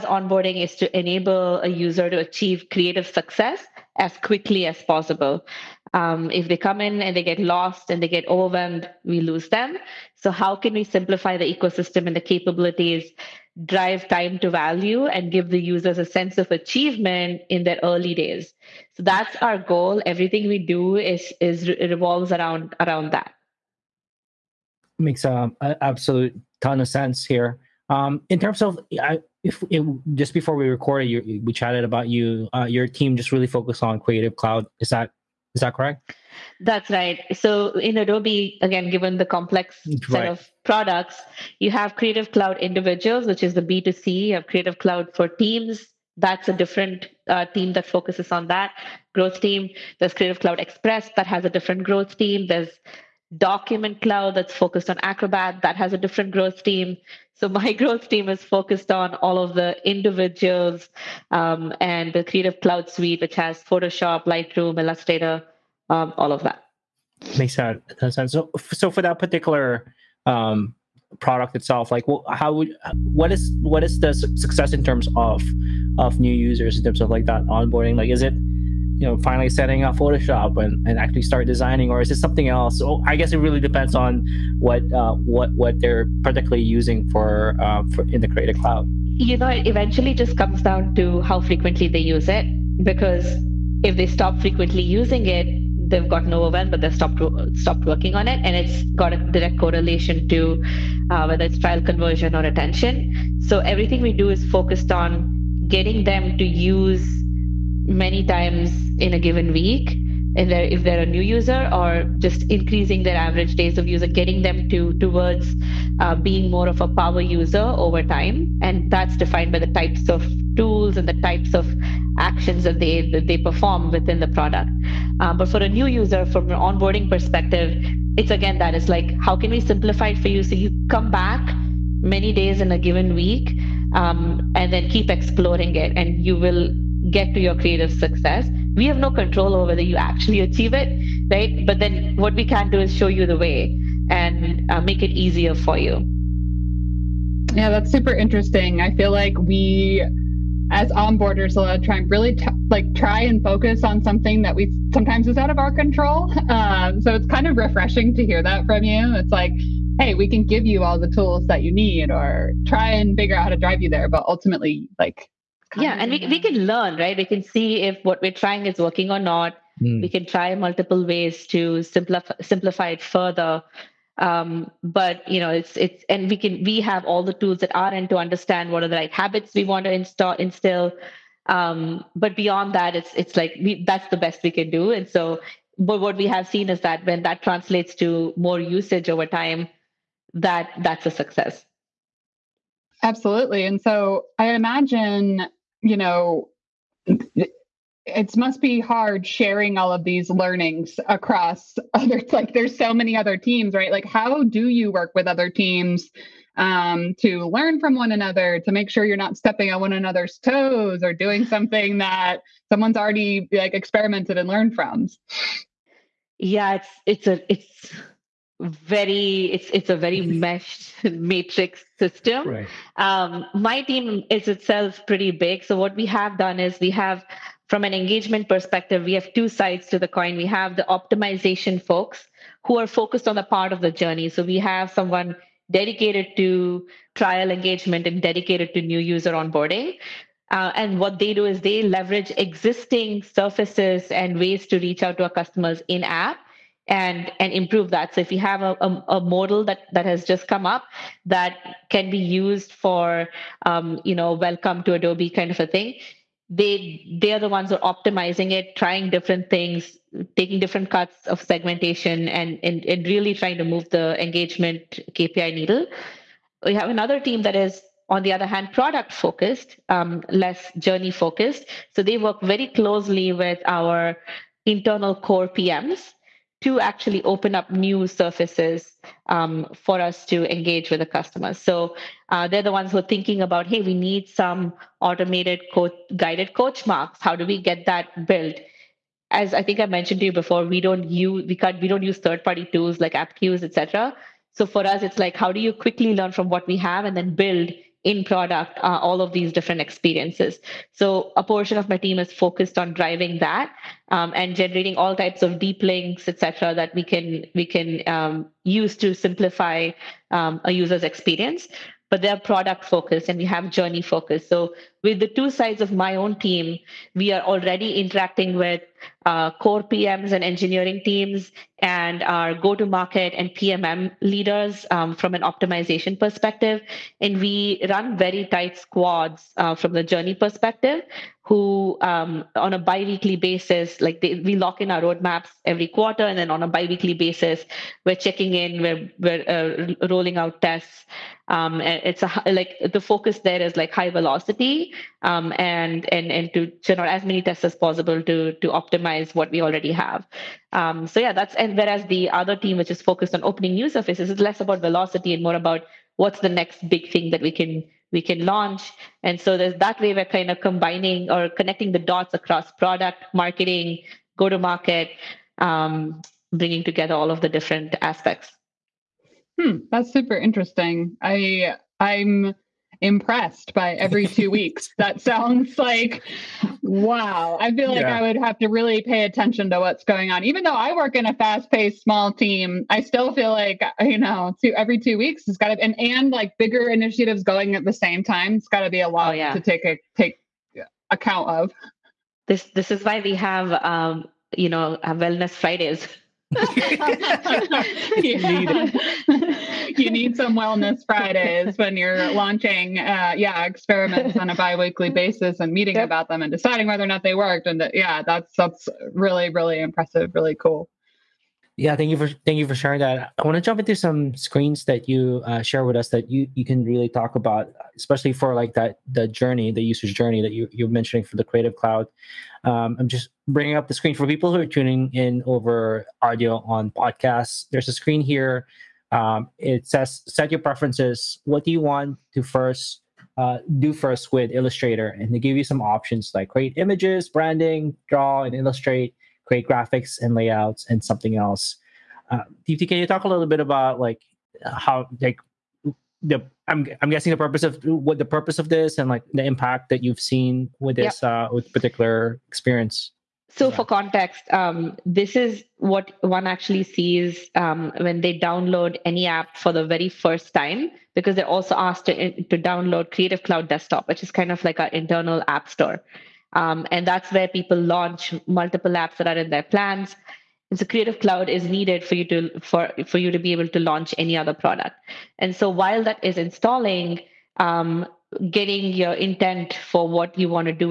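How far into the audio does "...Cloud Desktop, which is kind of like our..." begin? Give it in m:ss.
7:43.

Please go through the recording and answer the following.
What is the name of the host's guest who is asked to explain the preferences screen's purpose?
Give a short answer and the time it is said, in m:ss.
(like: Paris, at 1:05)
Deepti, at 7:22.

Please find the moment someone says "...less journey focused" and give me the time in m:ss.
4:30.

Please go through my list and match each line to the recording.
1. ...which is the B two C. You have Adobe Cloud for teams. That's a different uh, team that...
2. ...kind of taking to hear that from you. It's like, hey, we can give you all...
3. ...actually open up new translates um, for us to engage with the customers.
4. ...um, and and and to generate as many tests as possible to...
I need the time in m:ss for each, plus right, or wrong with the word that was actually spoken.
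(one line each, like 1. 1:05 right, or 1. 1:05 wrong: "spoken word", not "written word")
1. 0:43 wrong: "Creative", not "Adobe"
2. 2:37 wrong: "refreshing", not "taking"
3. 4:36 wrong: "surfaces", not "translates"
4. 5:45 right.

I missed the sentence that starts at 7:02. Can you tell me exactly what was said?
Um, I'm just bringing up the screen for people who are tuning in over audio on podcasts.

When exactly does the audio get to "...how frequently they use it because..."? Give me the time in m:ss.
1:31.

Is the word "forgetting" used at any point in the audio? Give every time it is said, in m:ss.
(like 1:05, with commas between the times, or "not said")
not said.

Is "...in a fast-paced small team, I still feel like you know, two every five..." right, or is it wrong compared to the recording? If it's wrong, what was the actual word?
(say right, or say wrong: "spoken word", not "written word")
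wrong: "two", not "five".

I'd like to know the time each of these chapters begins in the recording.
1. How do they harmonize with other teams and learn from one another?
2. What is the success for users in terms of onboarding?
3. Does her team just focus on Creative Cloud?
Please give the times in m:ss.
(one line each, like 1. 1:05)
1. 3:26
2. 1:16
3. 0:37.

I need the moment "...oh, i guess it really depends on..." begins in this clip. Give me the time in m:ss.
1:22.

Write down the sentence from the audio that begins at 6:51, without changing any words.
Yeah, thank you for thank you for sharing that.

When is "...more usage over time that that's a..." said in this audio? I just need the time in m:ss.
3:08.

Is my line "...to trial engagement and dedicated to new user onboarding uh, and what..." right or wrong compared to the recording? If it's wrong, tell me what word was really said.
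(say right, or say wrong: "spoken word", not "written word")
right.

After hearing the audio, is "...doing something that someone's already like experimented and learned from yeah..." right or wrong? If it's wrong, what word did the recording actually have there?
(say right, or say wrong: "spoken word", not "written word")
right.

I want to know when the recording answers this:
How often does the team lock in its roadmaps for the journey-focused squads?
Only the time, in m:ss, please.
5:35.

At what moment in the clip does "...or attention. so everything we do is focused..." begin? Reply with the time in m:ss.
1:42.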